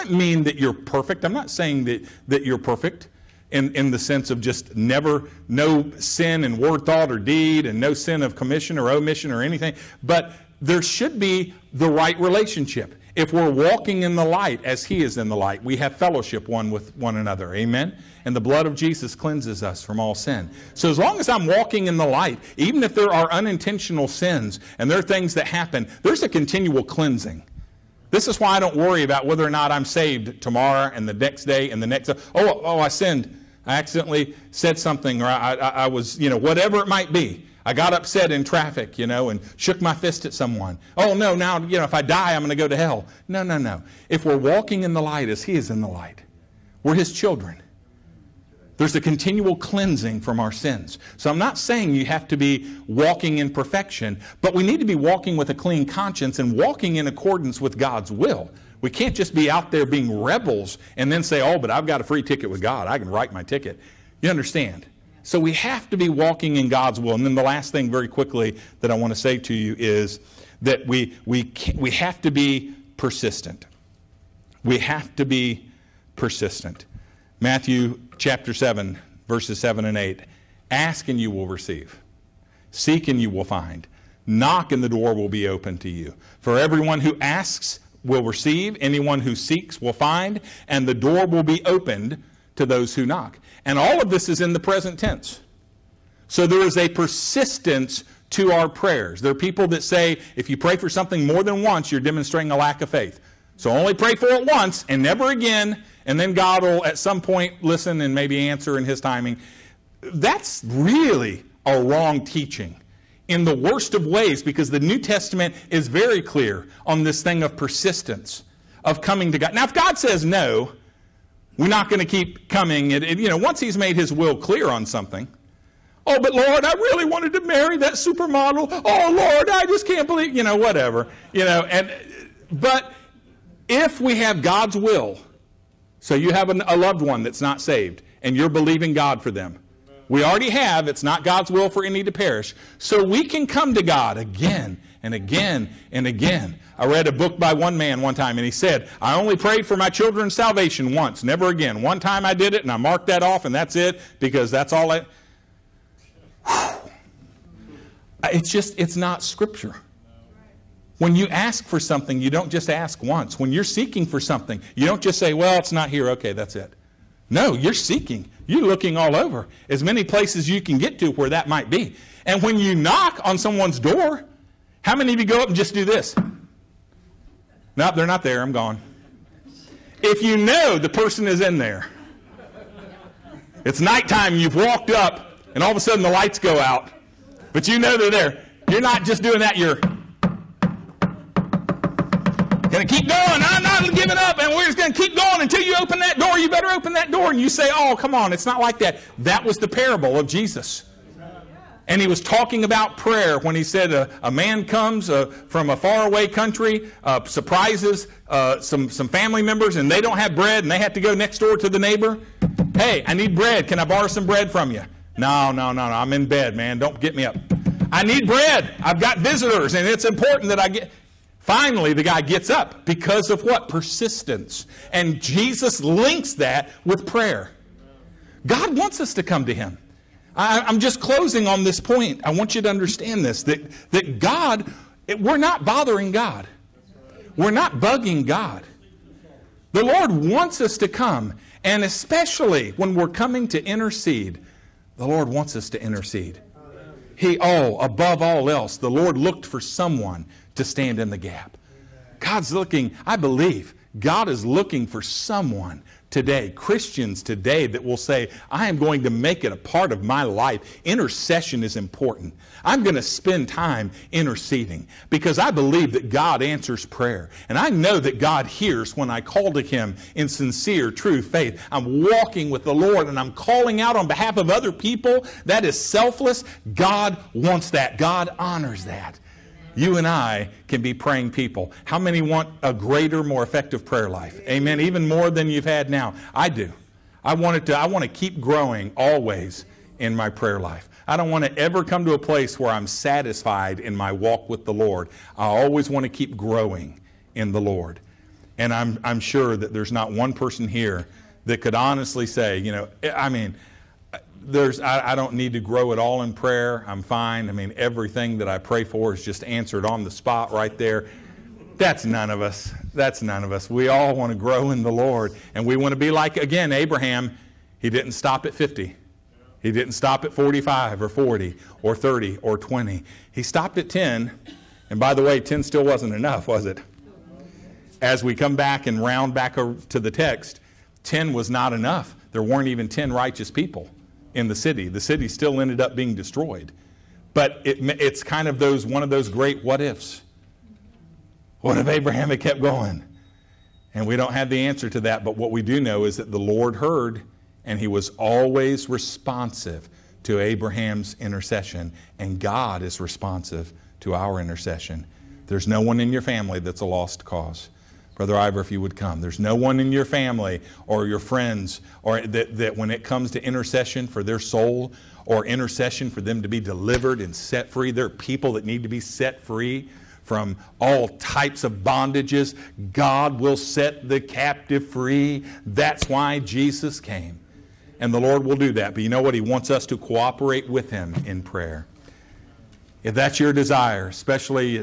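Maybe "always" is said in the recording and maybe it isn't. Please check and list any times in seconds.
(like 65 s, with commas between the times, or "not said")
288 s, 295 s, 348 s.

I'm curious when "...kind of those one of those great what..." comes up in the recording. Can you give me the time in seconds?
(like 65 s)
338 s.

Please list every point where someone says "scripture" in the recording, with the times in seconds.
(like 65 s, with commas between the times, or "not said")
159 s.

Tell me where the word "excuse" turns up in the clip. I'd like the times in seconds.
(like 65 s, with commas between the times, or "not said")
not said.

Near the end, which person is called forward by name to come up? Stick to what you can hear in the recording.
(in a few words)
Brother Ivor.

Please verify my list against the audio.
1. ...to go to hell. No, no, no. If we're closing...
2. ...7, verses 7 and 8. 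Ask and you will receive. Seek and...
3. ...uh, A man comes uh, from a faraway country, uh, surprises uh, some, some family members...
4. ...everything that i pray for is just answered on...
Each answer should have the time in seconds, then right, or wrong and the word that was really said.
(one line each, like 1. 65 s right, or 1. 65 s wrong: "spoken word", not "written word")
1. 42 s wrong: "walking", not "closing"
2. 78 s right
3. 203 s right
4. 307 s right.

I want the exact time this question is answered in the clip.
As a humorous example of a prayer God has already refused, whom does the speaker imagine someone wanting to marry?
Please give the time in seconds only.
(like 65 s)
127 s.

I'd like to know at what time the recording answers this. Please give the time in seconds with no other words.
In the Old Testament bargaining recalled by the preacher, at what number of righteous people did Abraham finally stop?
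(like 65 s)
323 s.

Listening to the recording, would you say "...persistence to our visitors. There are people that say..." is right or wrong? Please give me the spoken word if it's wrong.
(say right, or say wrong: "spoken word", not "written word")
wrong: "prayers", not "visitors".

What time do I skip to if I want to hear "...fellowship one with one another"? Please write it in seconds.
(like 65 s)
15 s.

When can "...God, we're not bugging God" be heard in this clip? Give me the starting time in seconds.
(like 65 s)
236 s.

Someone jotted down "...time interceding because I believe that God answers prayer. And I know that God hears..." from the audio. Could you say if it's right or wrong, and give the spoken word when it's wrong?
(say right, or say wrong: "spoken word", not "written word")
right.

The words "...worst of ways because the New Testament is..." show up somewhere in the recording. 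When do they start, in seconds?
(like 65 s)
113 s.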